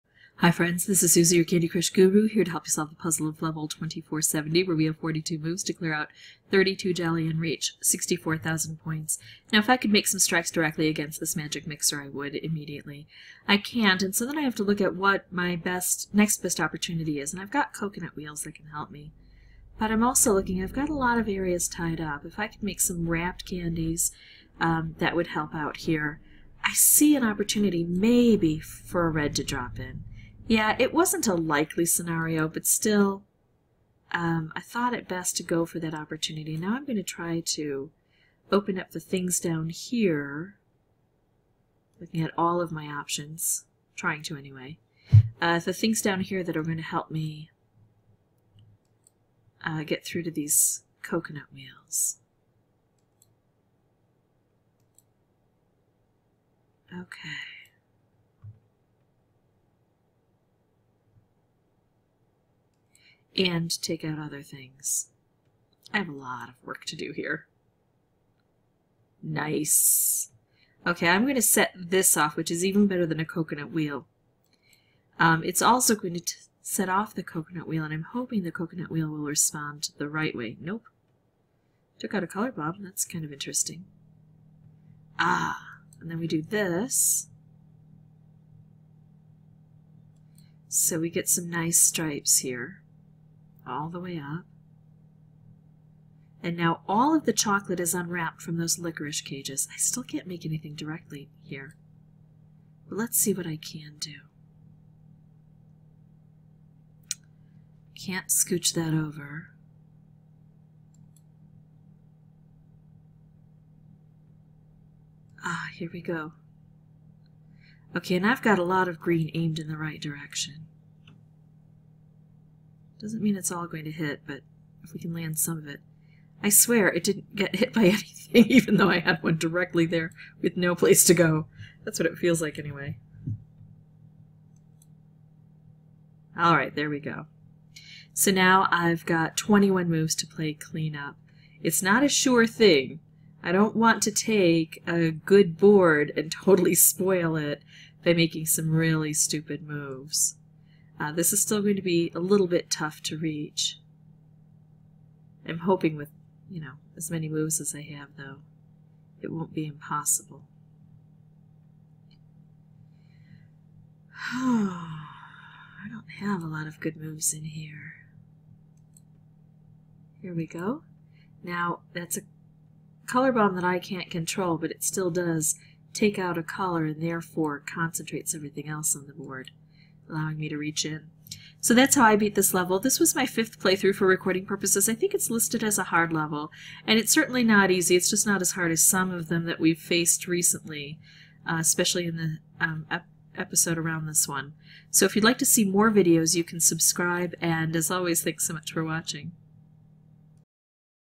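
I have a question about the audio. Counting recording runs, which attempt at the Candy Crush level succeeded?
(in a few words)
fifth.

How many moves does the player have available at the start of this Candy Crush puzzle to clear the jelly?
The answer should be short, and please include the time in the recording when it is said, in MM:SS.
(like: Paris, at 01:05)
42, at 00:04.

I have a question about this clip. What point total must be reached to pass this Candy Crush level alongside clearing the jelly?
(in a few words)
64,000.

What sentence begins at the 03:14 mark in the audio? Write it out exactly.
So if you'd like to see more videos, you can subscribe, and as always, thanks so much for watching.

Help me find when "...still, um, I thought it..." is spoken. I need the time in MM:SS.
00:32.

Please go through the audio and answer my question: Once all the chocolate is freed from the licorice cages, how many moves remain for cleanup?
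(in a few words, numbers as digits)
21.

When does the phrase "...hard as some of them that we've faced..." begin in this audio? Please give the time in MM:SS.
03:08.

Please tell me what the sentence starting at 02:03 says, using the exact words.
Doesn't mean it's all going to hit, but if we can land some of it.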